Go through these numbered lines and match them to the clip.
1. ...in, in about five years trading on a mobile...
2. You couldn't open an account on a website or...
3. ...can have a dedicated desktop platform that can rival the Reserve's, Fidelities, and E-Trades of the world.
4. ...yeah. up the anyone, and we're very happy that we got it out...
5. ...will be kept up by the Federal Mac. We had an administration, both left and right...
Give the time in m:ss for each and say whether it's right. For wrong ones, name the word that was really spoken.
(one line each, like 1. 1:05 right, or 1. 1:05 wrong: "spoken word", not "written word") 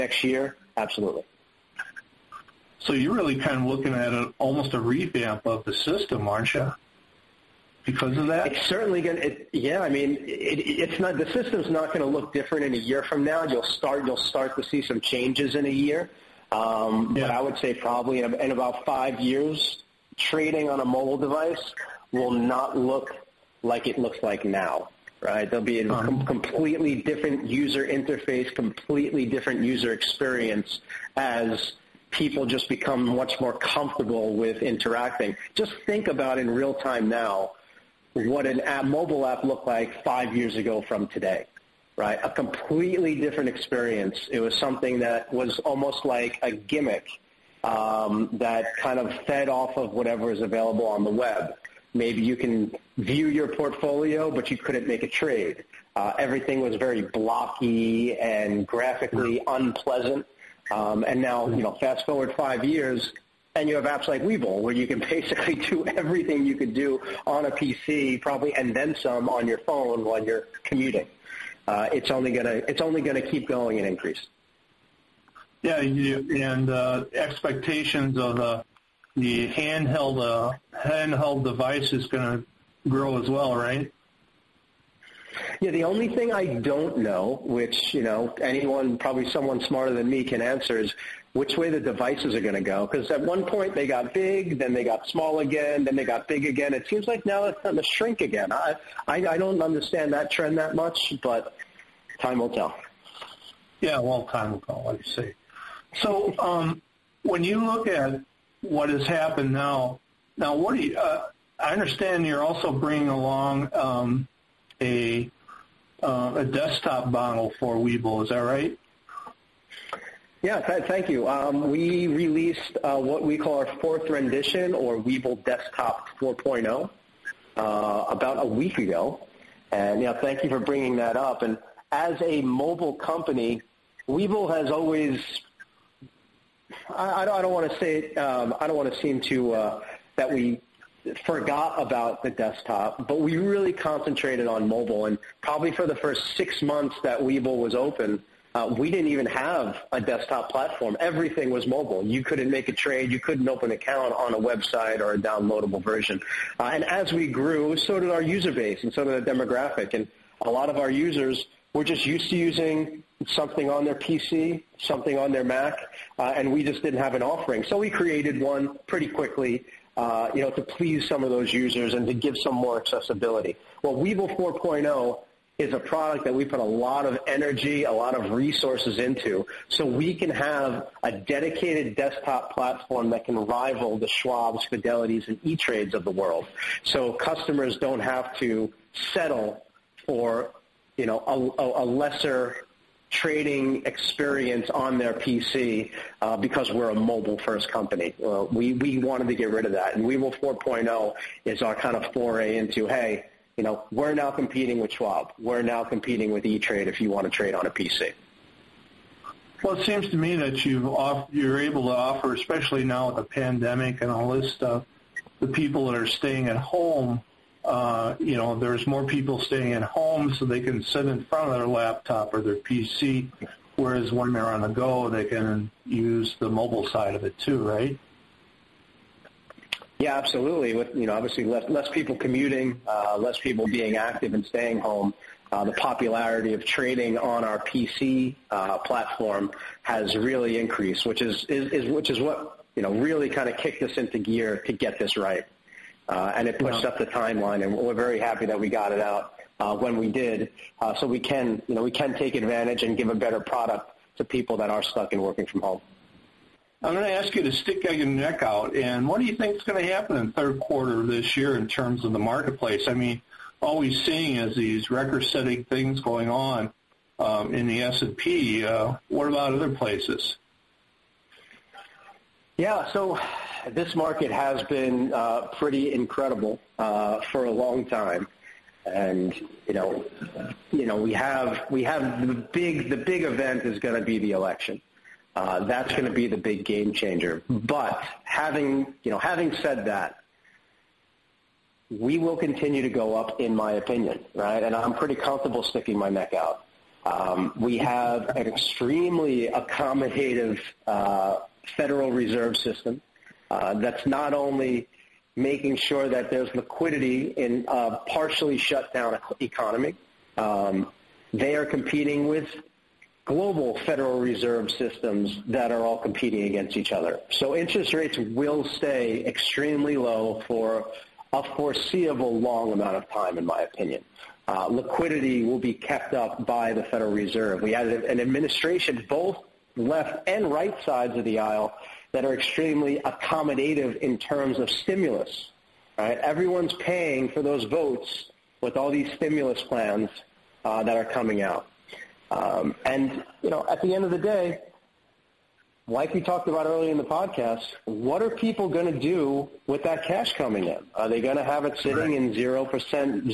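1. 0:18 right
2. 2:33 right
3. 3:00 wrong: "Schwab", not "Reserve"
4. 4:06 wrong: "timeline", not "anyone"
5. 5:25 wrong: "Reserve", not "Mac".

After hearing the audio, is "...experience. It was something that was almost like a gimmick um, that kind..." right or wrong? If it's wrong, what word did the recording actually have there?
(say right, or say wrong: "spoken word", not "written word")
right.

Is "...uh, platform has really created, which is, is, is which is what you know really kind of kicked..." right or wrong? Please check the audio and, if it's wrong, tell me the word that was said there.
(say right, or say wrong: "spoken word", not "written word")
wrong: "increased", not "created".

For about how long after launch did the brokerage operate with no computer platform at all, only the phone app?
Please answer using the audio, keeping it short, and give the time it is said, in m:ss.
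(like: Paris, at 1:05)
6 months, at 2:26.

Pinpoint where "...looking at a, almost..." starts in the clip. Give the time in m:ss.
0:03.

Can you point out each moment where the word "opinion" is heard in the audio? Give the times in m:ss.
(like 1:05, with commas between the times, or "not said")
4:53, 5:23.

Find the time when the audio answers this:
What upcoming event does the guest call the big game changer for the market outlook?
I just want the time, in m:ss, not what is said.
4:44.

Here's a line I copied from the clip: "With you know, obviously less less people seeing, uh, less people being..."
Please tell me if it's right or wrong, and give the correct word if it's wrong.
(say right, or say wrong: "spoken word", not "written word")
wrong: "commuting", not "seeing".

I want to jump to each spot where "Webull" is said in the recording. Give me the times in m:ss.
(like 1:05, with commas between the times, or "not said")
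1:04, 1:57, 2:04, 2:14, 2:27, 2:53, 3:20.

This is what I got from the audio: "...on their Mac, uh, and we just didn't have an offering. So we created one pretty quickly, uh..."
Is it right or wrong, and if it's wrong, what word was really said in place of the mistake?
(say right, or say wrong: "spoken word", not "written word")
right.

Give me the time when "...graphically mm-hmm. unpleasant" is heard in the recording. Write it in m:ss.
0:58.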